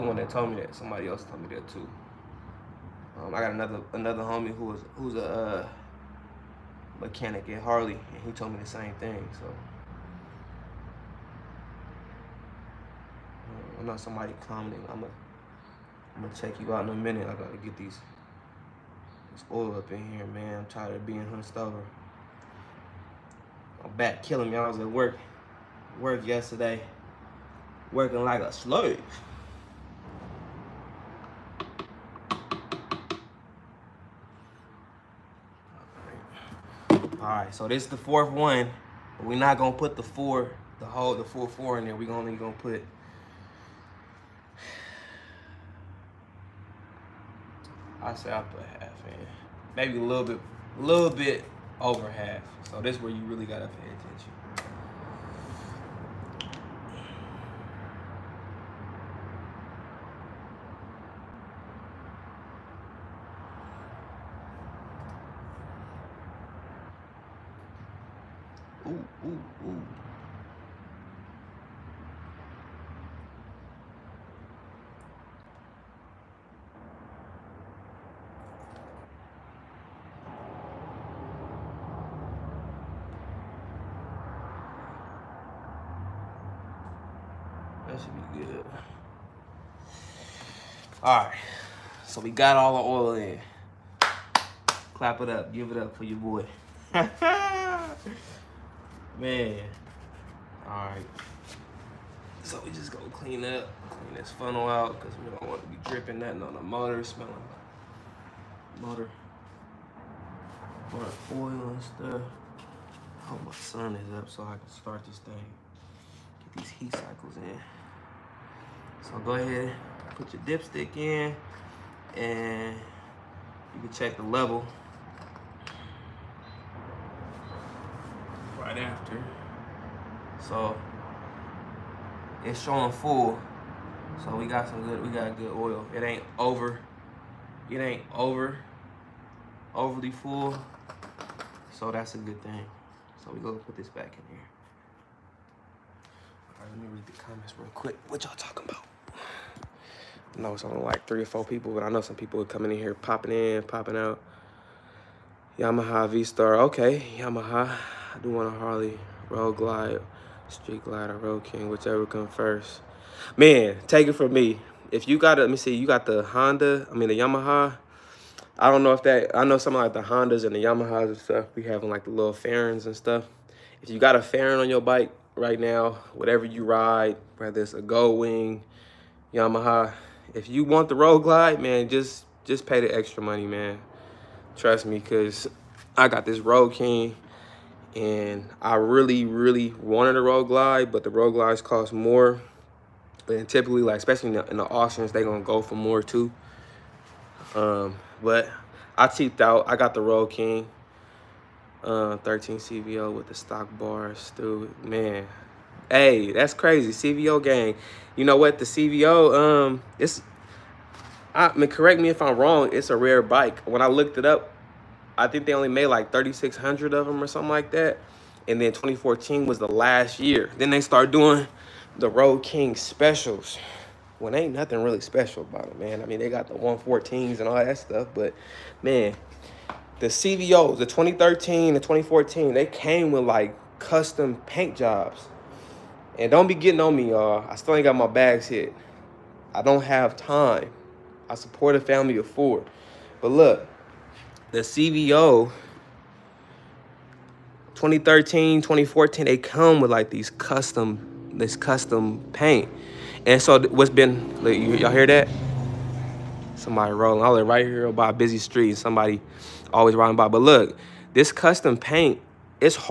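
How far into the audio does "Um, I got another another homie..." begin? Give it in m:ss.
0:03.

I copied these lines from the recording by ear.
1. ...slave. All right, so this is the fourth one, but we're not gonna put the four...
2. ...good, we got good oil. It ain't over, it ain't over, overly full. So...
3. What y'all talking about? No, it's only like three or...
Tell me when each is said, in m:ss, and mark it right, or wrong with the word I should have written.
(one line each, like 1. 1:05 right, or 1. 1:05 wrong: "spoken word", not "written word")
1. 0:28 right
2. 2:14 right
3. 2:28 right.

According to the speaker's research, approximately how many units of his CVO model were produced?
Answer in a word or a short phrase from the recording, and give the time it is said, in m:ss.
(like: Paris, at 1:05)
3,600, at 3:36.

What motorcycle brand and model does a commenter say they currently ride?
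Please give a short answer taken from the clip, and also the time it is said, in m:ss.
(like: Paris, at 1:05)
Yamaha V-Star, at 2:35.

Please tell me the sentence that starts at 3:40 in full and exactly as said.
Then they start doing the Road King specials.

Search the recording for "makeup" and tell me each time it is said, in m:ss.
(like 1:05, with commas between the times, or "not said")
not said.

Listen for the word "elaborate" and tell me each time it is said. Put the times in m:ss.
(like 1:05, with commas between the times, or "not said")
not said.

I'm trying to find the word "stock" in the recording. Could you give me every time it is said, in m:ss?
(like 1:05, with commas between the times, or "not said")
3:23.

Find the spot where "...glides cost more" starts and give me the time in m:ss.
3:11.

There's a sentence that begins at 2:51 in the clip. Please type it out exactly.
We having like the little fairings and stuff.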